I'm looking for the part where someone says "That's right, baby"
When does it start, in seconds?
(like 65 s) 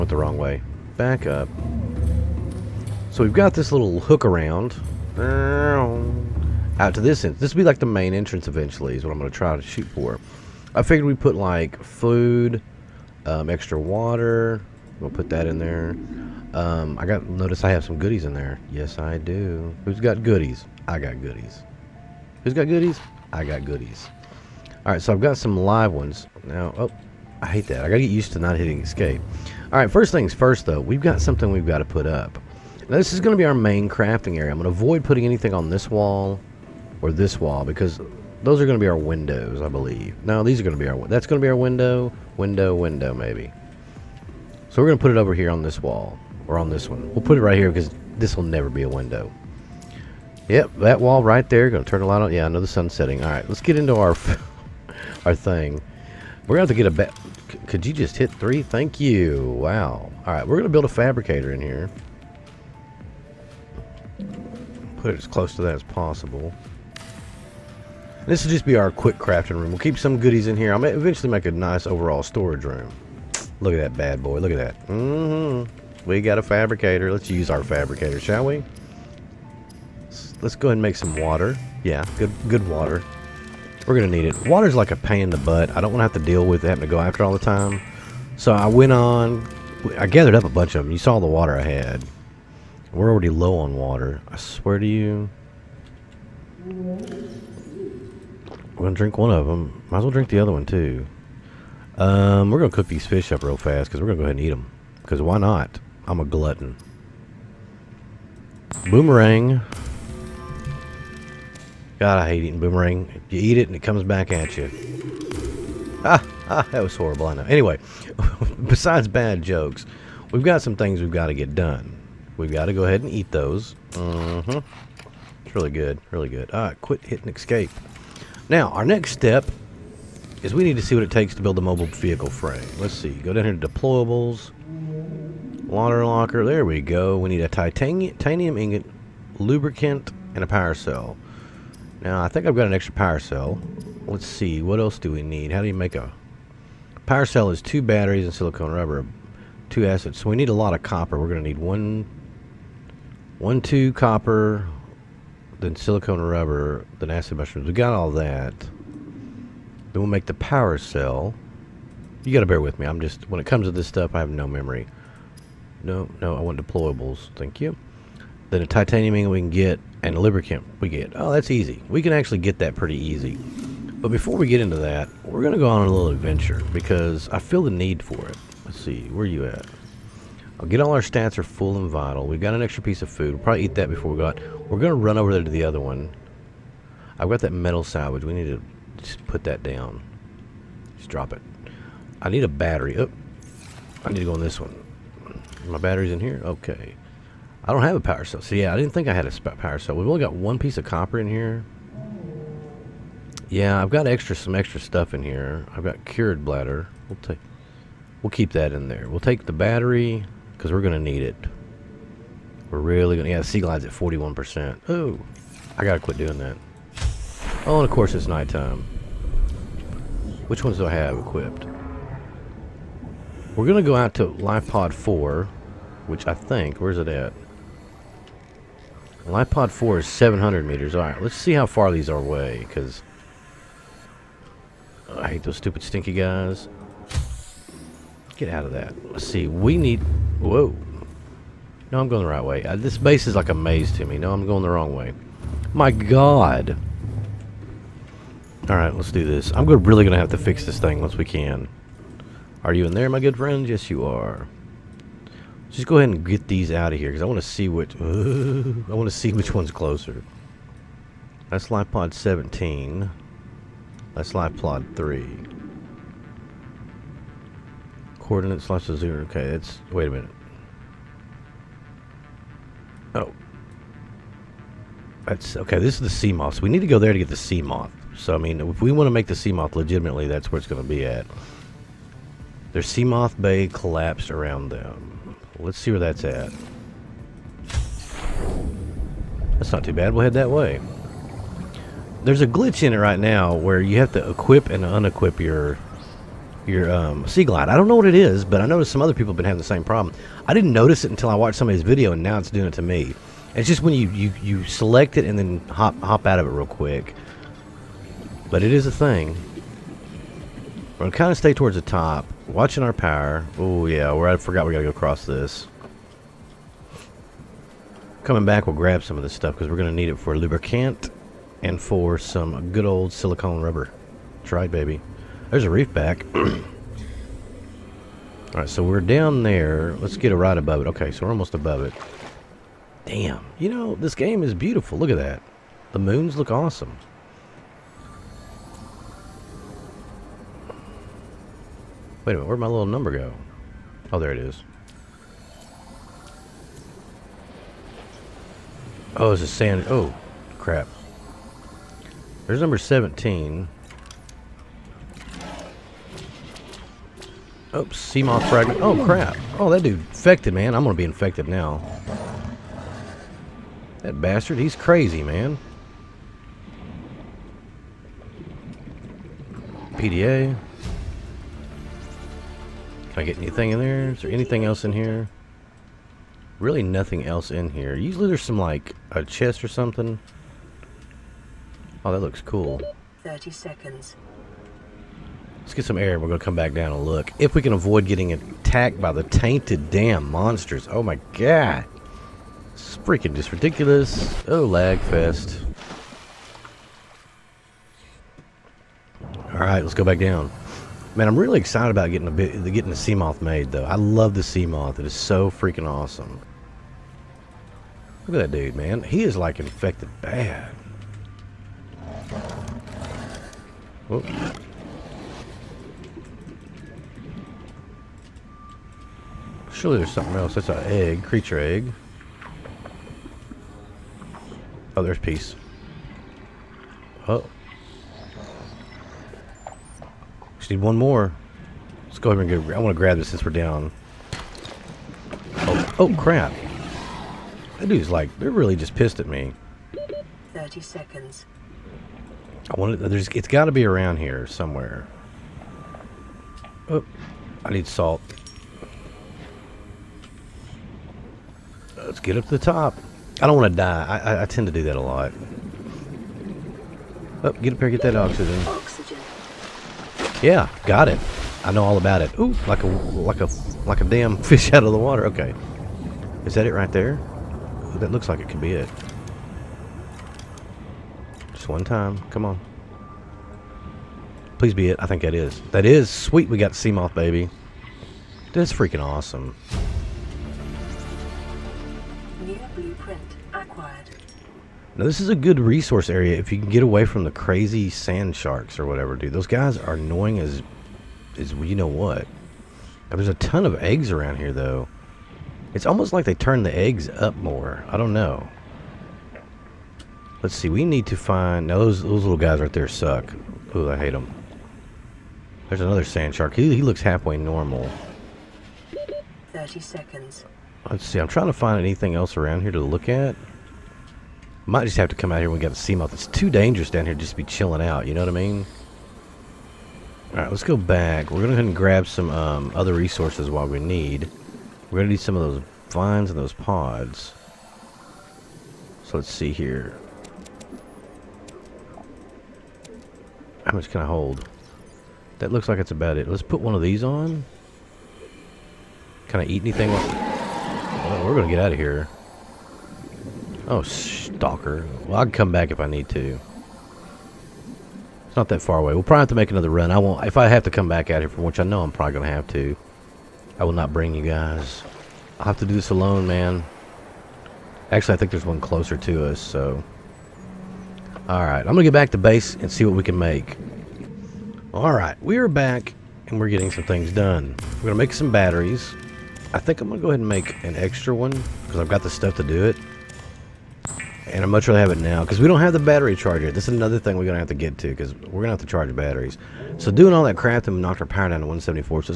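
324 s.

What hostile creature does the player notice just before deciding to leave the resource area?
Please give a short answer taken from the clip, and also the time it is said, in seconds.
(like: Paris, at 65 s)
Stalker, at 543 s.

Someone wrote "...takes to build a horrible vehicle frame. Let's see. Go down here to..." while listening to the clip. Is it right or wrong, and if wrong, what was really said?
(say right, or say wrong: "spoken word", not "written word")
wrong: "mobile", not "horrible".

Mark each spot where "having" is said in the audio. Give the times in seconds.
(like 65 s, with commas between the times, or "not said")
86 s, 299 s.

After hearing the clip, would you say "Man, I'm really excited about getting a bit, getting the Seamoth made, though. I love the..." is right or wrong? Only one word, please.
right.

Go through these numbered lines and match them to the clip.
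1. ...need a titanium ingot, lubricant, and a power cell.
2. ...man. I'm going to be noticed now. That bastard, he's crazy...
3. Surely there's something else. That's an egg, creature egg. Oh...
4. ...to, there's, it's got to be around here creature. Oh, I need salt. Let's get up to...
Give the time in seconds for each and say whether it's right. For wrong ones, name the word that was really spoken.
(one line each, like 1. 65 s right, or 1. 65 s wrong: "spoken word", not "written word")
1. 137 s right
2. 360 s wrong: "infected", not "noticed"
3. 419 s right
4. 442 s wrong: "somewhere", not "creature".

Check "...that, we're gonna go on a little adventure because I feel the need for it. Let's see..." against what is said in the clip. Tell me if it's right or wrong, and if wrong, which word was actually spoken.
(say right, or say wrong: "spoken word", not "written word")
right.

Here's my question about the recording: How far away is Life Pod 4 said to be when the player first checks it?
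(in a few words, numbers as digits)
700 meters.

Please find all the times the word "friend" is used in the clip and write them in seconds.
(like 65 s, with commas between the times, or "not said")
253 s.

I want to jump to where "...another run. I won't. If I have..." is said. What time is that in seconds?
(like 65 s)
549 s.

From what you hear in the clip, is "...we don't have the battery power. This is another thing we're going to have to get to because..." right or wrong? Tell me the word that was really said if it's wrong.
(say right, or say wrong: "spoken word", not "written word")
wrong: "charger", not "power".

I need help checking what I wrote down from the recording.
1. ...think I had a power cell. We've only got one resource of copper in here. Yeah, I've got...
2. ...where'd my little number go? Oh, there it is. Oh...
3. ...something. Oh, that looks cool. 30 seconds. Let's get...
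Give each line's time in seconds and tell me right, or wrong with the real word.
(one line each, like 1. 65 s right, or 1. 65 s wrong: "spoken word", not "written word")
1. 198 s wrong: "piece", not "resource"
2. 342 s right
3. 379 s right.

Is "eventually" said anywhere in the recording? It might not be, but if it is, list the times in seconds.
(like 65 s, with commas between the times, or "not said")
8 s, 70 s.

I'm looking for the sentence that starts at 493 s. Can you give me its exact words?
Now, there's a ton of eggs around here, though.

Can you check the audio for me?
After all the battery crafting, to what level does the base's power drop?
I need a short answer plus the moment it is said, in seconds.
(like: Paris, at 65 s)
174, at 581 s.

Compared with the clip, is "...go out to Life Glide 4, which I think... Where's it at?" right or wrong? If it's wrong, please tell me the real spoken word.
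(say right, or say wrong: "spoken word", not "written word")
wrong: "Pod", not "Glide".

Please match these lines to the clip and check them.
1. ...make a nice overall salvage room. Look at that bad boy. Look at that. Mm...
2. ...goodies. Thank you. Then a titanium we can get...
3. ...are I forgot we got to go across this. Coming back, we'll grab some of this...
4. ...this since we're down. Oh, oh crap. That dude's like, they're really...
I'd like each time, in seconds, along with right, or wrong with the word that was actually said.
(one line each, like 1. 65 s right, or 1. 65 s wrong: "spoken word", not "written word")
1. 71 s wrong: "storage", not "salvage"
2. 166 s wrong: "deployables", not "goodies"
3. 314 s right
4. 433 s right.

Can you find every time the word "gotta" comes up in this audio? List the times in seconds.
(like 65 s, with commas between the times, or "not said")
27 s, 162 s.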